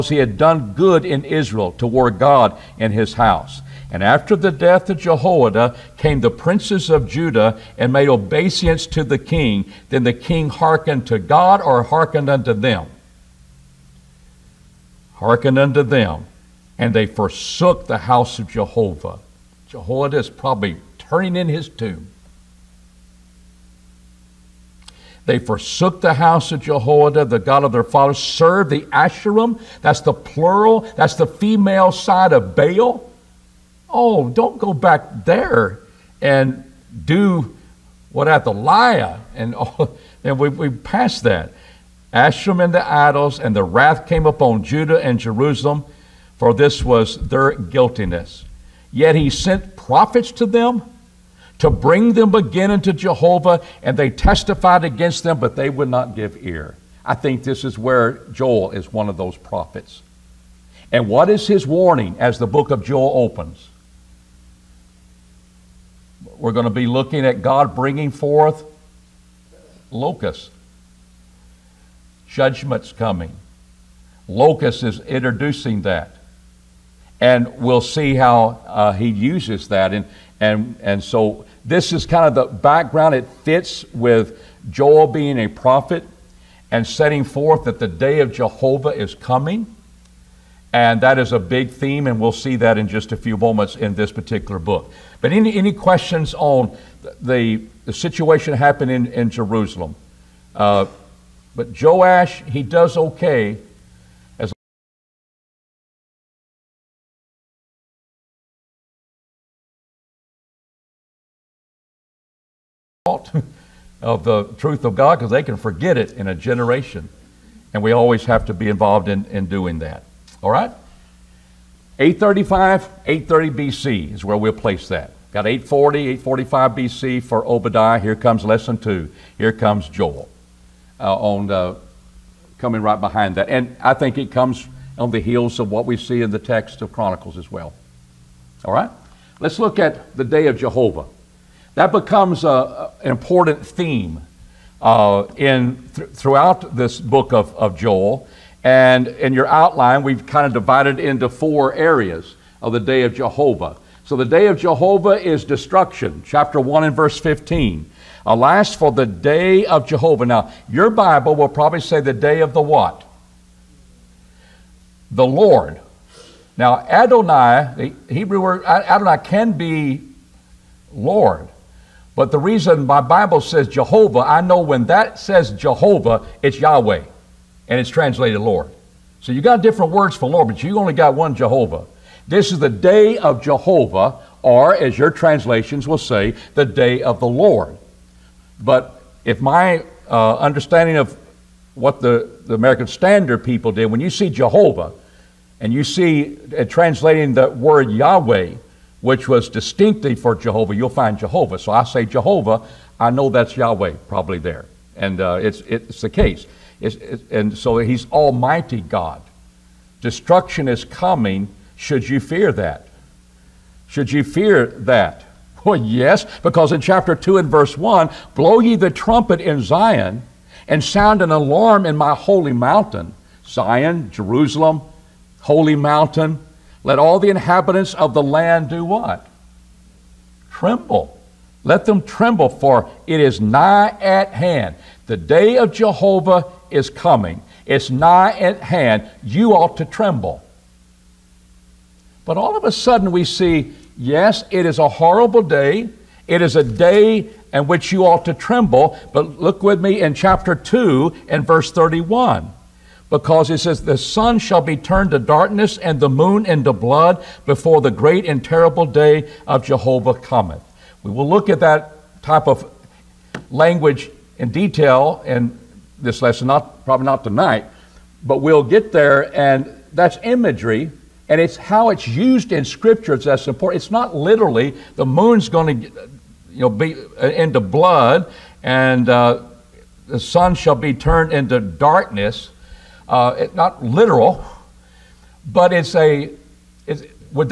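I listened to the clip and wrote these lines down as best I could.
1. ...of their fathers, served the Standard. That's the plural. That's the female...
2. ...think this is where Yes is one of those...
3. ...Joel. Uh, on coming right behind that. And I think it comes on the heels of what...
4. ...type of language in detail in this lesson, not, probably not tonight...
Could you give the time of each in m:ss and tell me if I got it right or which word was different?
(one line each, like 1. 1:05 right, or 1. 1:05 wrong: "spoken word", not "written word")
1. 0:27 wrong: "Asherim", not "Standard"
2. 0:57 wrong: "Joel", not "Yes"
3. 2:09 right
4. 4:22 right.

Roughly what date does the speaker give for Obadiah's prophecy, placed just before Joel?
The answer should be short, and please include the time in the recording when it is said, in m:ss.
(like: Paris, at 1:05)
840, 845 BC, at 2:05.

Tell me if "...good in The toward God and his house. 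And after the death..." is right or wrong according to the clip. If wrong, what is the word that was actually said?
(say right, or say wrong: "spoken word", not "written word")
wrong: "Israel", not "The".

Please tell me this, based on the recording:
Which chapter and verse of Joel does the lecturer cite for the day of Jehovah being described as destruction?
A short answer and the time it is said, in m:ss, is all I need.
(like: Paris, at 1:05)
Chapter 1, verse 15, at 2:36.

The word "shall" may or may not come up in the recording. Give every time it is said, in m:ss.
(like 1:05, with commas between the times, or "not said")
4:14, 4:40.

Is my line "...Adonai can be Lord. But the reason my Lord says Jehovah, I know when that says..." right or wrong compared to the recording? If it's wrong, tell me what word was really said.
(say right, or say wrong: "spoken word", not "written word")
wrong: "Bible", not "Lord".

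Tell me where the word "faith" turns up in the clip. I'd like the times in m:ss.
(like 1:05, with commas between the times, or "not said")
not said.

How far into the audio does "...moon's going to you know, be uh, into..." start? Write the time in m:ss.
4:35.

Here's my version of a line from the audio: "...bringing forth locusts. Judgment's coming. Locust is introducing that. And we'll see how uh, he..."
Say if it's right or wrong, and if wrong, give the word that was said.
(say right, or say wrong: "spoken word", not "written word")
right.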